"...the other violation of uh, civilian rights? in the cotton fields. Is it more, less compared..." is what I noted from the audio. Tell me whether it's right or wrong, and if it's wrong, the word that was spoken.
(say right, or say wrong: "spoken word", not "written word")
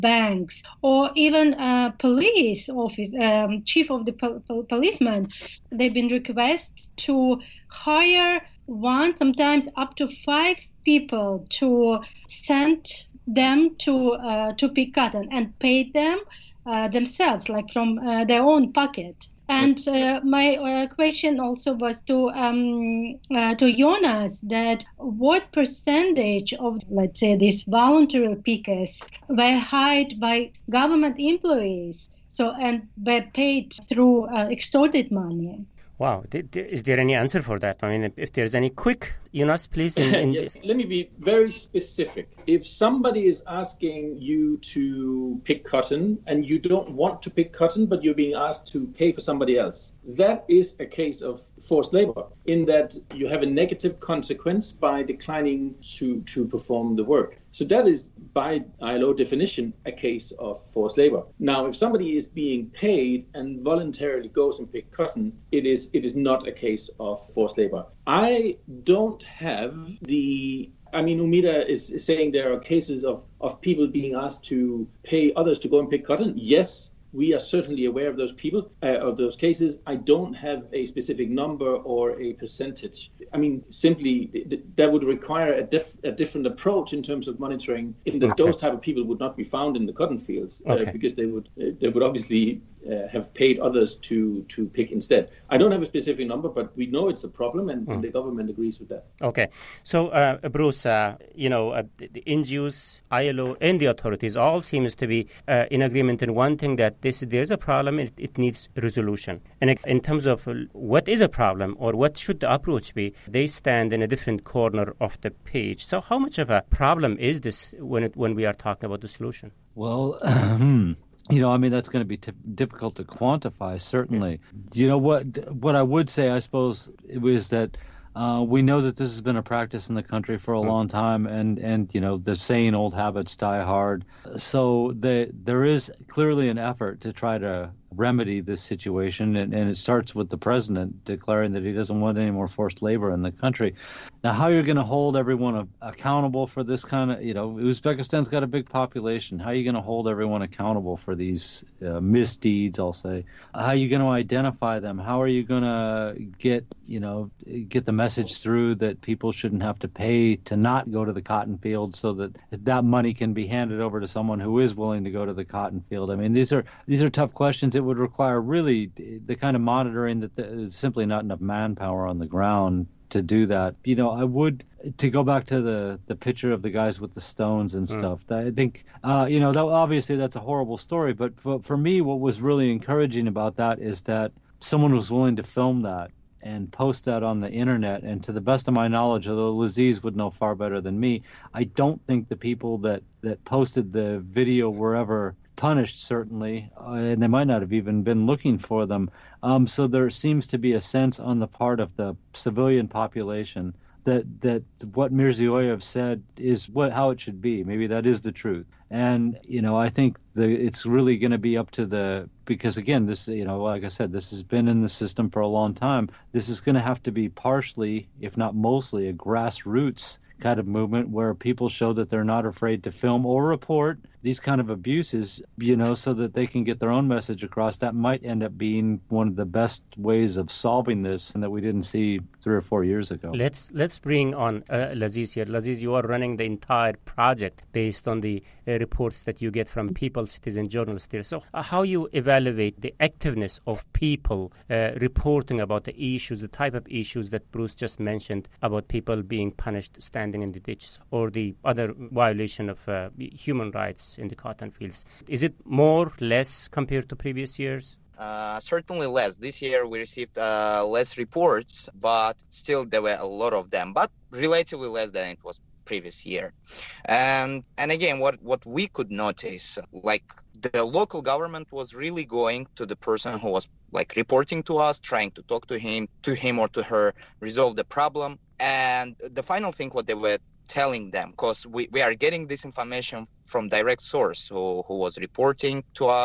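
wrong: "human", not "civilian".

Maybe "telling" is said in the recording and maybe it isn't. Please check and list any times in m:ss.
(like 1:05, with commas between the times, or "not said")
4:40.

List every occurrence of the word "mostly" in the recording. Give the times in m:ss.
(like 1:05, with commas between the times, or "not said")
3:38.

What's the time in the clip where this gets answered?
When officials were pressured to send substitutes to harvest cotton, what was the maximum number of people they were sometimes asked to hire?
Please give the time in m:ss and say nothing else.
0:10.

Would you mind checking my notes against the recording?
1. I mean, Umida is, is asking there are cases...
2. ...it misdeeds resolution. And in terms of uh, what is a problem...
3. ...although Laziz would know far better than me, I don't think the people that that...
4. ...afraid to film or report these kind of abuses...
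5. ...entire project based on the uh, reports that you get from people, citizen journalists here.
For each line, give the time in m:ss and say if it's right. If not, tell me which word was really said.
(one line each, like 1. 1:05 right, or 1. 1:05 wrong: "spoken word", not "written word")
1. 1:10 wrong: "saying", not "asking"
2. 1:48 wrong: "needs", not "misdeeds"
3. 3:09 right
4. 3:42 right
5. 3:56 right.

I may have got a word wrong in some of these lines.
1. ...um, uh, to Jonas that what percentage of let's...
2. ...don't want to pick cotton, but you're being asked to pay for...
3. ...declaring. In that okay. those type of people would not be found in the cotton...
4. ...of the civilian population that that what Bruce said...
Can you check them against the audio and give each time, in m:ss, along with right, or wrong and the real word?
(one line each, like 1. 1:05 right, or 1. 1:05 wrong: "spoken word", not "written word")
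1. 0:22 right
2. 0:46 right
3. 1:27 wrong: "monitoring", not "declaring"
4. 3:21 wrong: "Mirziyoyev", not "Bruce".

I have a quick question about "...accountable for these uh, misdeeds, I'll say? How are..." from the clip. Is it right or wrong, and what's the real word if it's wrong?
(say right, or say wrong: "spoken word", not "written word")
right.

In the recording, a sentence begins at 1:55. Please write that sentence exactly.
So how much of a problem is this when it, when we are talking about the solution?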